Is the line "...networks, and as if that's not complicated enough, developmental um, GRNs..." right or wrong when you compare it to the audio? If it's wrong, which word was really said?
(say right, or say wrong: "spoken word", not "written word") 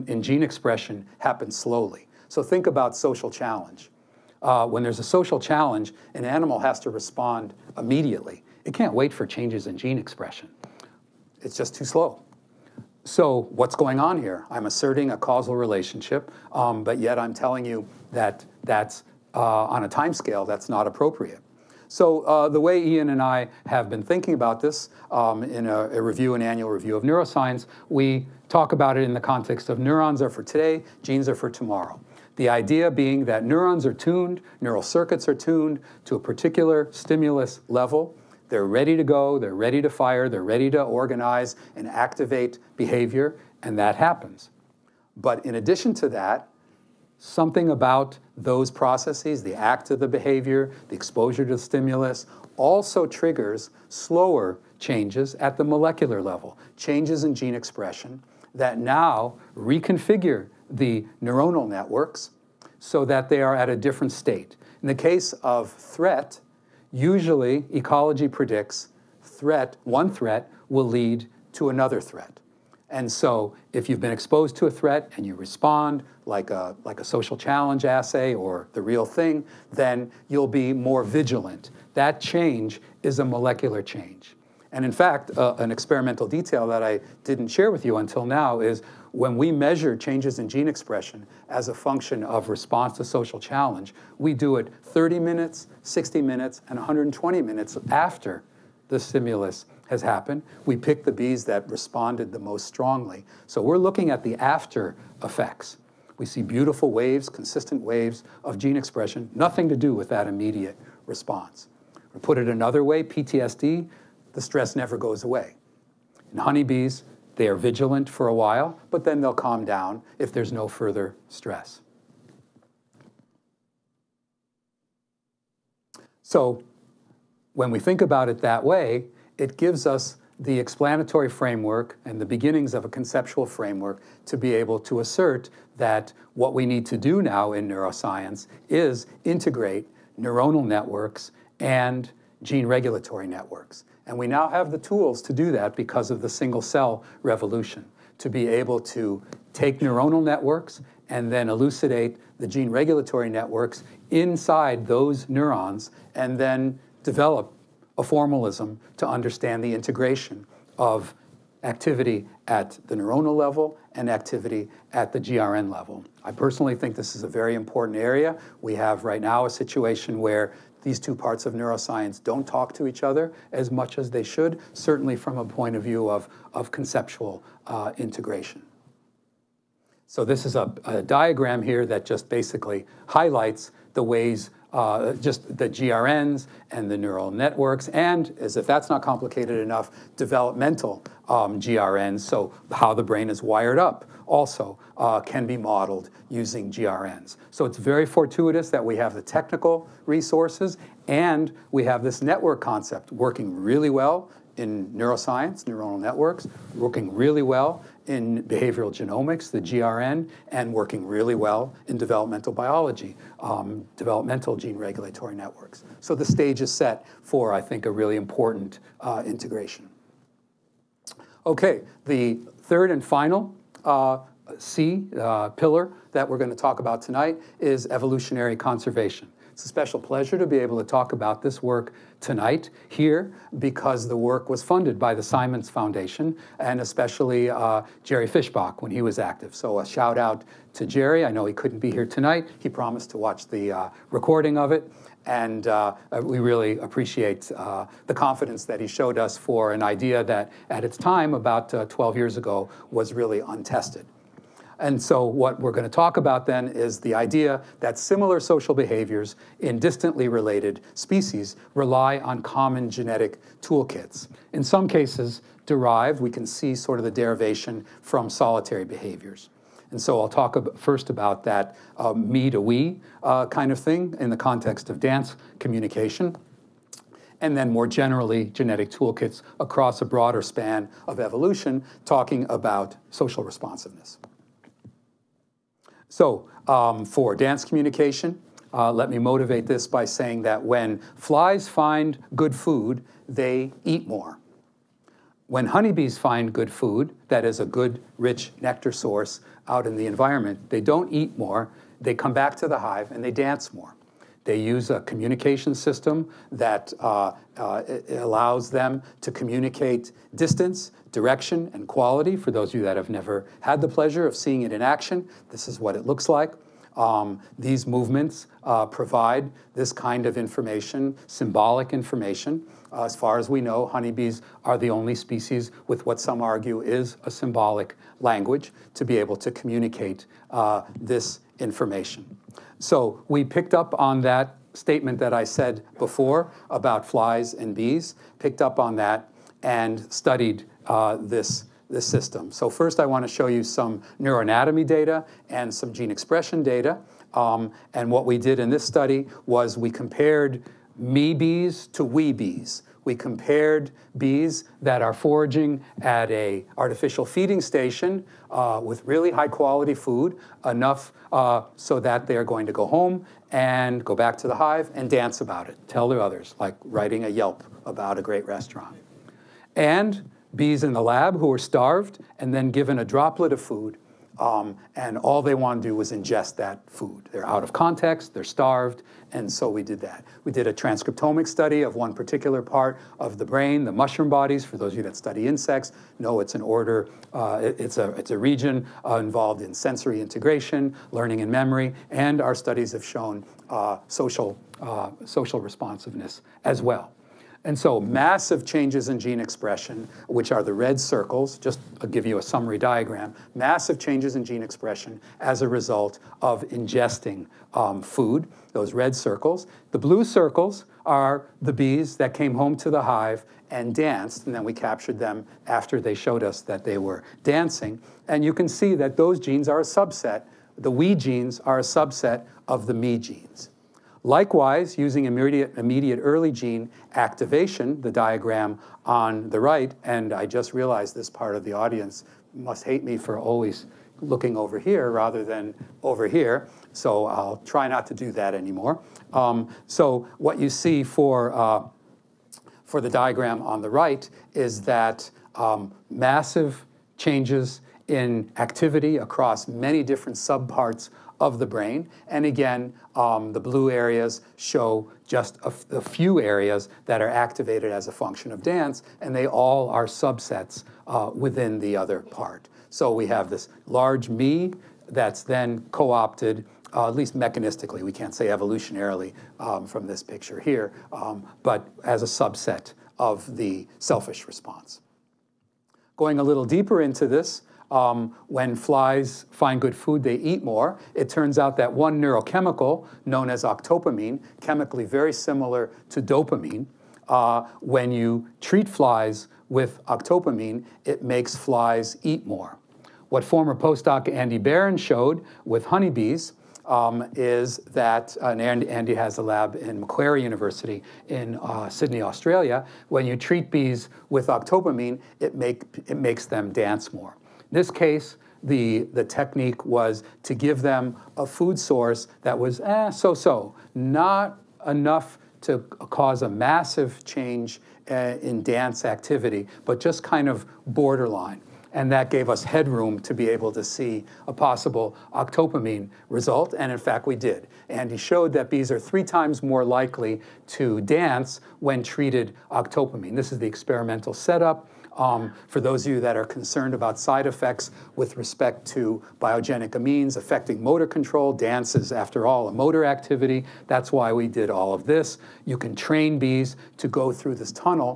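right.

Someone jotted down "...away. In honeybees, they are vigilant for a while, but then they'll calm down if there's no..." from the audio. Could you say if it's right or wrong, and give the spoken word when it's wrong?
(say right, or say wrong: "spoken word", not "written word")
right.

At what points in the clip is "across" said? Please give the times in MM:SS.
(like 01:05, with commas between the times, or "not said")
04:39, 07:29.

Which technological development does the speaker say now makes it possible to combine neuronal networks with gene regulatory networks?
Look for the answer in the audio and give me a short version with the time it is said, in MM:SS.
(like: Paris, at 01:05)
single cell revolution, at 02:26.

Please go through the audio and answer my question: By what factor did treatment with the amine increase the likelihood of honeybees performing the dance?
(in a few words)
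3 times.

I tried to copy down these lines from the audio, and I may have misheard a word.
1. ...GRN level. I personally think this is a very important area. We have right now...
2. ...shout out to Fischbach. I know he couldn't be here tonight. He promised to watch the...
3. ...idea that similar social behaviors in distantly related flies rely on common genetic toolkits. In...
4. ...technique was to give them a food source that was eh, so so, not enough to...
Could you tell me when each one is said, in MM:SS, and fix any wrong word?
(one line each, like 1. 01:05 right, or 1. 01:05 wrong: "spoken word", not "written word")
1. 02:45 right
2. 03:59 wrong: "Jerry", not "Fischbach"
3. 04:17 wrong: "species", not "flies"
4. 08:29 right.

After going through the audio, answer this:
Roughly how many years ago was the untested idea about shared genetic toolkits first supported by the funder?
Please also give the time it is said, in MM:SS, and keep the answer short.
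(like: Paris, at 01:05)
12 years, at 04:11.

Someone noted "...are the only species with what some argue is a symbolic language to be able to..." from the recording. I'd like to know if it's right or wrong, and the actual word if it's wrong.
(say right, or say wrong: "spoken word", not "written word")
right.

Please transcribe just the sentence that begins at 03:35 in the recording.
So the stage is set for, I think, a really important uh, integration.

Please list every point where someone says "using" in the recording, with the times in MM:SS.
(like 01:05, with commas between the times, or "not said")
03:16, 07:04.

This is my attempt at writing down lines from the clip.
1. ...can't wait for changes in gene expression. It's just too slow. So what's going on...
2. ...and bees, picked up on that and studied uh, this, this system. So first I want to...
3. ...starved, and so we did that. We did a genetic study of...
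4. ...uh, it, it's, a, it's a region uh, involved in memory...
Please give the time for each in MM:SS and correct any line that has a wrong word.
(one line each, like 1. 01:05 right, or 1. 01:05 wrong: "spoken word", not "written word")
1. 00:08 right
2. 05:37 right
3. 06:18 wrong: "transcriptomic", not "genetic"
4. 06:27 wrong: "sensory", not "memory".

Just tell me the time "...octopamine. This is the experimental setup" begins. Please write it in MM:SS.
08:52.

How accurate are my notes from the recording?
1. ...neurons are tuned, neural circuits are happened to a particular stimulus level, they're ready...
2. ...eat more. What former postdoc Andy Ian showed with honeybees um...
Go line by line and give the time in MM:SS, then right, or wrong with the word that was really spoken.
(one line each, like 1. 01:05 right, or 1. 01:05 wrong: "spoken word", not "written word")
1. 00:33 wrong: "tuned", not "happened"
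2. 08:12 wrong: "Barron", not "Ian".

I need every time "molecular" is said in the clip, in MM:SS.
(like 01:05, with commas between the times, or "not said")
00:55, 01:23.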